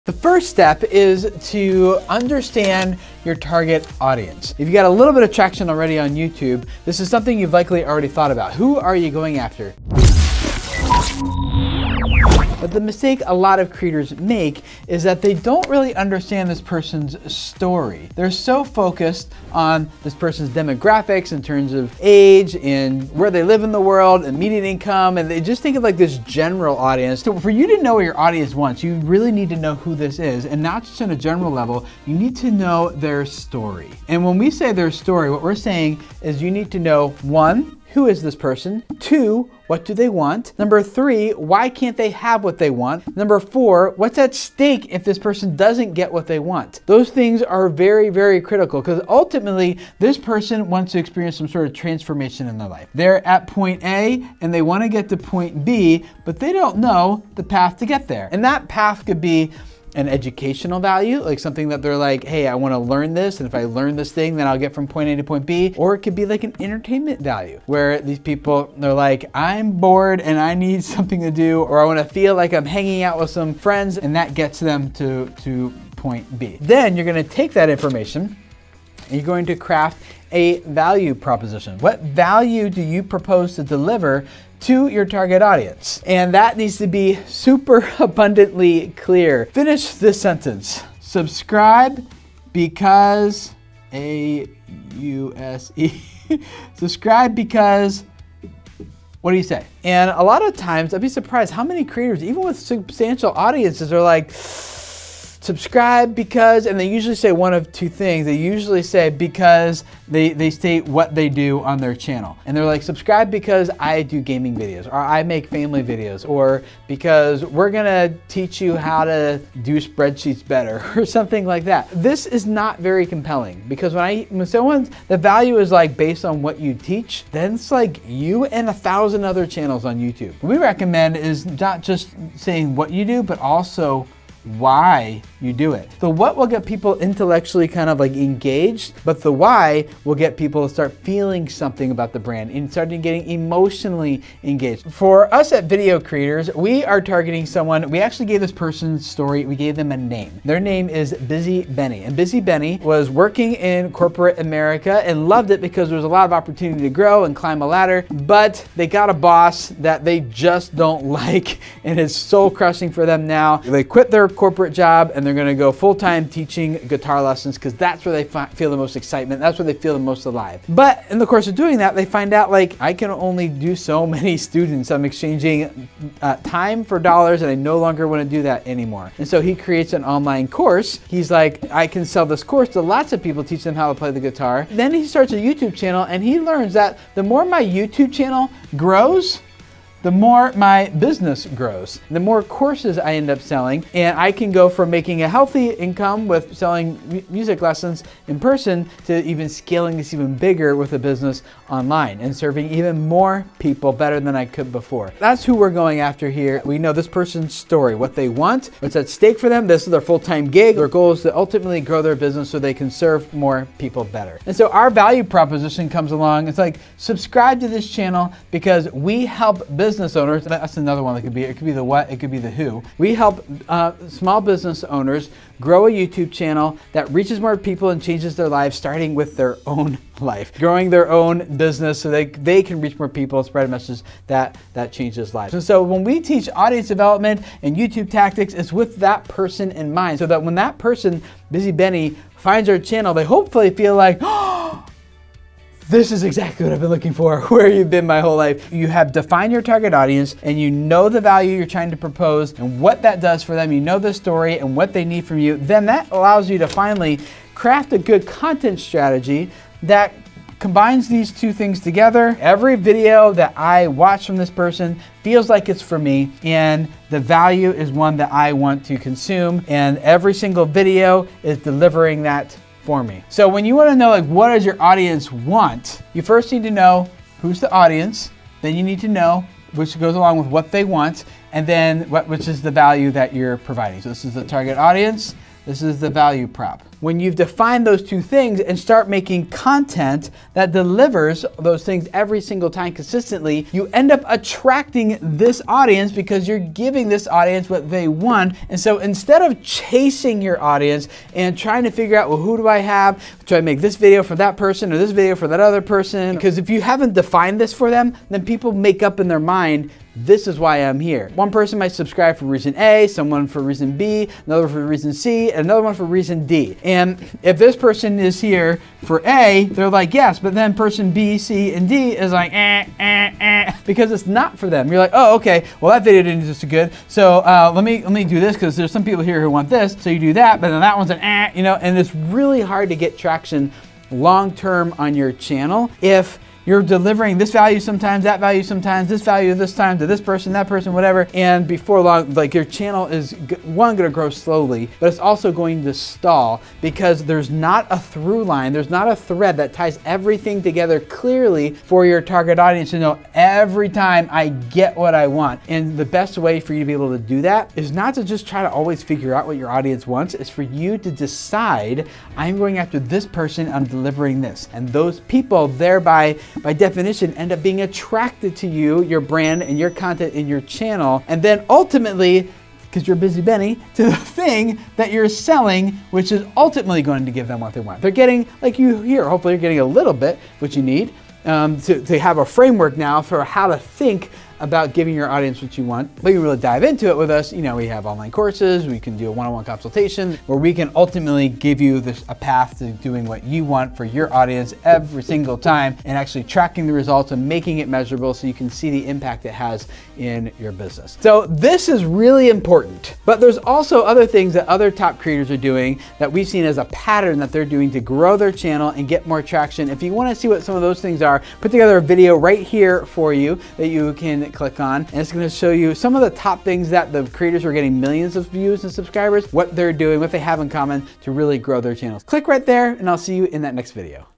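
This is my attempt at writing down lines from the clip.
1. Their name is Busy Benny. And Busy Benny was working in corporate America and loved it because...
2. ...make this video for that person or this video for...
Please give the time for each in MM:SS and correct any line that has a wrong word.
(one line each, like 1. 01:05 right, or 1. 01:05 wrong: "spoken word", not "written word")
1. 02:30 right
2. 05:03 right.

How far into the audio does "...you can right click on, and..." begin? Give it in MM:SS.
06:53.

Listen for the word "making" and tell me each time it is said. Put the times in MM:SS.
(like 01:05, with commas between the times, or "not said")
03:14, 04:49, 06:37.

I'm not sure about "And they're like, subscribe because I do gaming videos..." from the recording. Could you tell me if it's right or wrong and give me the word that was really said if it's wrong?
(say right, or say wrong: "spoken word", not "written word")
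right.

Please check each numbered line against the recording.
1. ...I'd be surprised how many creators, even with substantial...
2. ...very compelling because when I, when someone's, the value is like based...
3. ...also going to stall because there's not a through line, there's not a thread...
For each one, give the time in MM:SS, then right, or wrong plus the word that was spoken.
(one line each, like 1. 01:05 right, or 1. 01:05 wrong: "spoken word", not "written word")
1. 01:40 right
2. 02:02 right
3. 05:45 right.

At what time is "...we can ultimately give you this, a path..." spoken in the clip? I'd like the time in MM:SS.
06:30.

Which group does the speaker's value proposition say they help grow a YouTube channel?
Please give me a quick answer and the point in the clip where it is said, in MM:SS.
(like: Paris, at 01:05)
Small business owners, at 03:44.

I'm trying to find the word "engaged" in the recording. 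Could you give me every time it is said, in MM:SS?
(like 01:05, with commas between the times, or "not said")
02:18, 02:24.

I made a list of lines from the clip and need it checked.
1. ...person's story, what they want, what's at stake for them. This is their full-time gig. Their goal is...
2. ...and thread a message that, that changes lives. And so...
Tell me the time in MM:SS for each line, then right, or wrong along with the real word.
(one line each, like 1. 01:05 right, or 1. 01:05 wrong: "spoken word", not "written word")
1. 03:27 right
2. 03:53 wrong: "spread", not "thread".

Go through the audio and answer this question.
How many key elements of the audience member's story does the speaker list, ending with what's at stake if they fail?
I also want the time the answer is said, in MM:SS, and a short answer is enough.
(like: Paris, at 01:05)
4, at 00:43.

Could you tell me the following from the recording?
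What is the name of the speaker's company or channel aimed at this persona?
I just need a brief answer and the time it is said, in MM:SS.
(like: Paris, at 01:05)
Video Creators, at 02:25.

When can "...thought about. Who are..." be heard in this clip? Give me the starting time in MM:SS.
00:08.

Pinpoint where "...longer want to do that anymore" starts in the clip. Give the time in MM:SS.
02:57.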